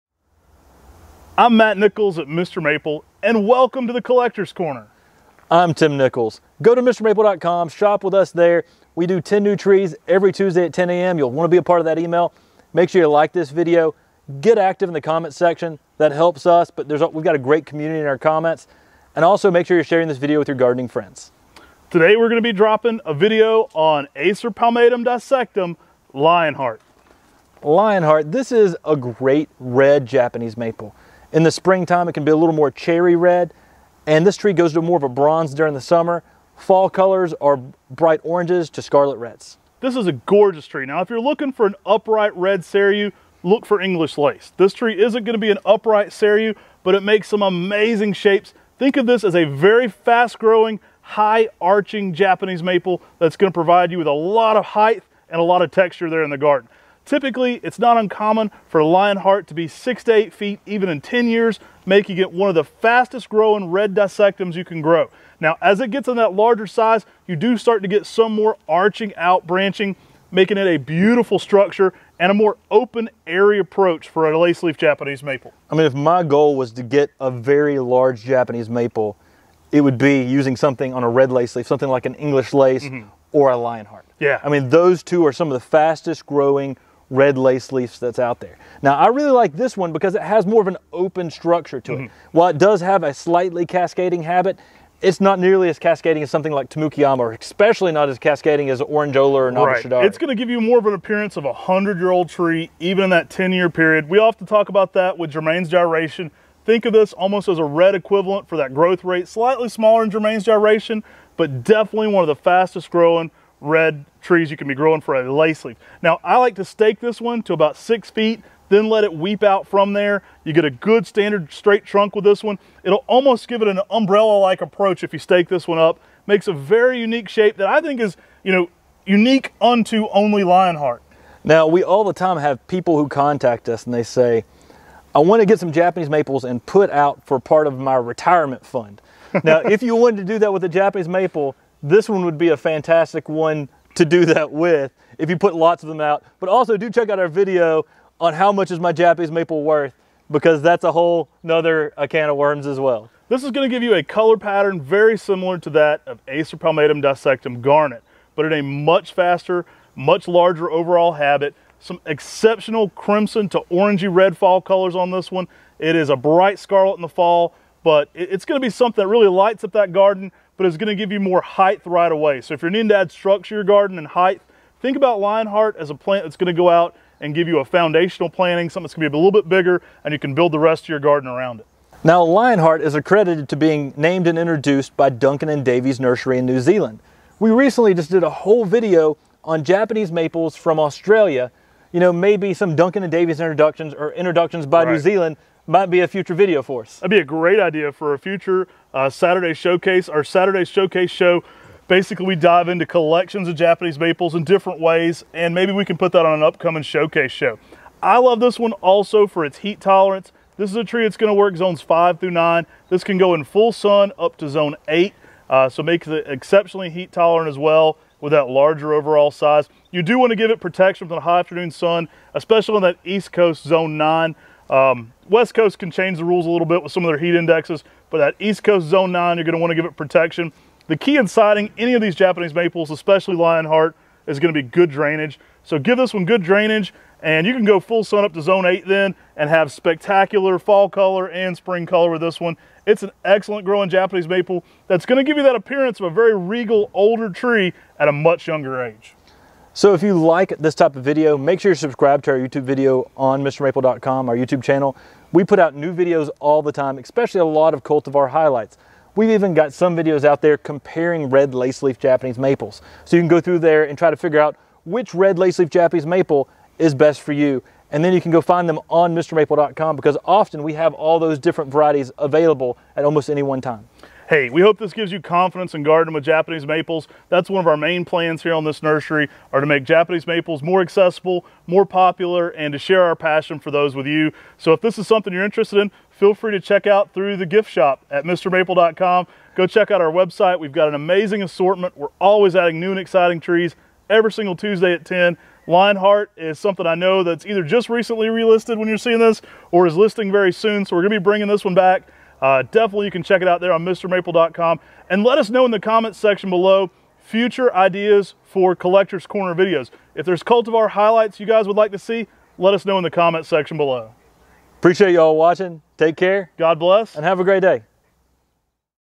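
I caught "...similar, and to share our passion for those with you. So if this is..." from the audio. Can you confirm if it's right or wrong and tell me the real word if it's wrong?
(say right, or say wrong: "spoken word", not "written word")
wrong: "popular", not "similar".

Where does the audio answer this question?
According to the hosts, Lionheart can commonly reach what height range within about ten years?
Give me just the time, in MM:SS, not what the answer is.
00:59.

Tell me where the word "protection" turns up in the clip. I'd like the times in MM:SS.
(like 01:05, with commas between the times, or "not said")
03:40, 03:49.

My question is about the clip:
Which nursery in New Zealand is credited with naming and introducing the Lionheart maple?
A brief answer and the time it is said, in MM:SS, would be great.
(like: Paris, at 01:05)
Duncan and Davies Nursery, at 03:05.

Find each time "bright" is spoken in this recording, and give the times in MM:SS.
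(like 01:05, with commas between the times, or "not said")
00:37, 02:46.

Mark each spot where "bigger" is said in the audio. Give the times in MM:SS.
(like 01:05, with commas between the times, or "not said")
02:59.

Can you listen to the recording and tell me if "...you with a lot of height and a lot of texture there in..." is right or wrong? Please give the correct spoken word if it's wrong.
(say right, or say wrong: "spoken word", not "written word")
right.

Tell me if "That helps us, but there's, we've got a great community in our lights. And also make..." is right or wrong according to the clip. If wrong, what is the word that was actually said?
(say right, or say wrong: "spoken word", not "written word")
wrong: "comments", not "lights".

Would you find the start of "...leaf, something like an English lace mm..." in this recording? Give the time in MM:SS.
01:21.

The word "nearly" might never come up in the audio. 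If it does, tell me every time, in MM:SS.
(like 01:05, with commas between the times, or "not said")
01:35.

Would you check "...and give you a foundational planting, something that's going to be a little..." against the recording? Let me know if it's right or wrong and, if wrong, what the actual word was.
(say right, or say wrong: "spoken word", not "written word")
right.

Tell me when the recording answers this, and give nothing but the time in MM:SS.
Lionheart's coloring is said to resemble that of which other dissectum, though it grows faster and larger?
02:37.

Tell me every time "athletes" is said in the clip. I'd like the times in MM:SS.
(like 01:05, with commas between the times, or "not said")
not said.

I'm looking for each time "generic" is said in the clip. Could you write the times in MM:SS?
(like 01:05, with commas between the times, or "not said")
not said.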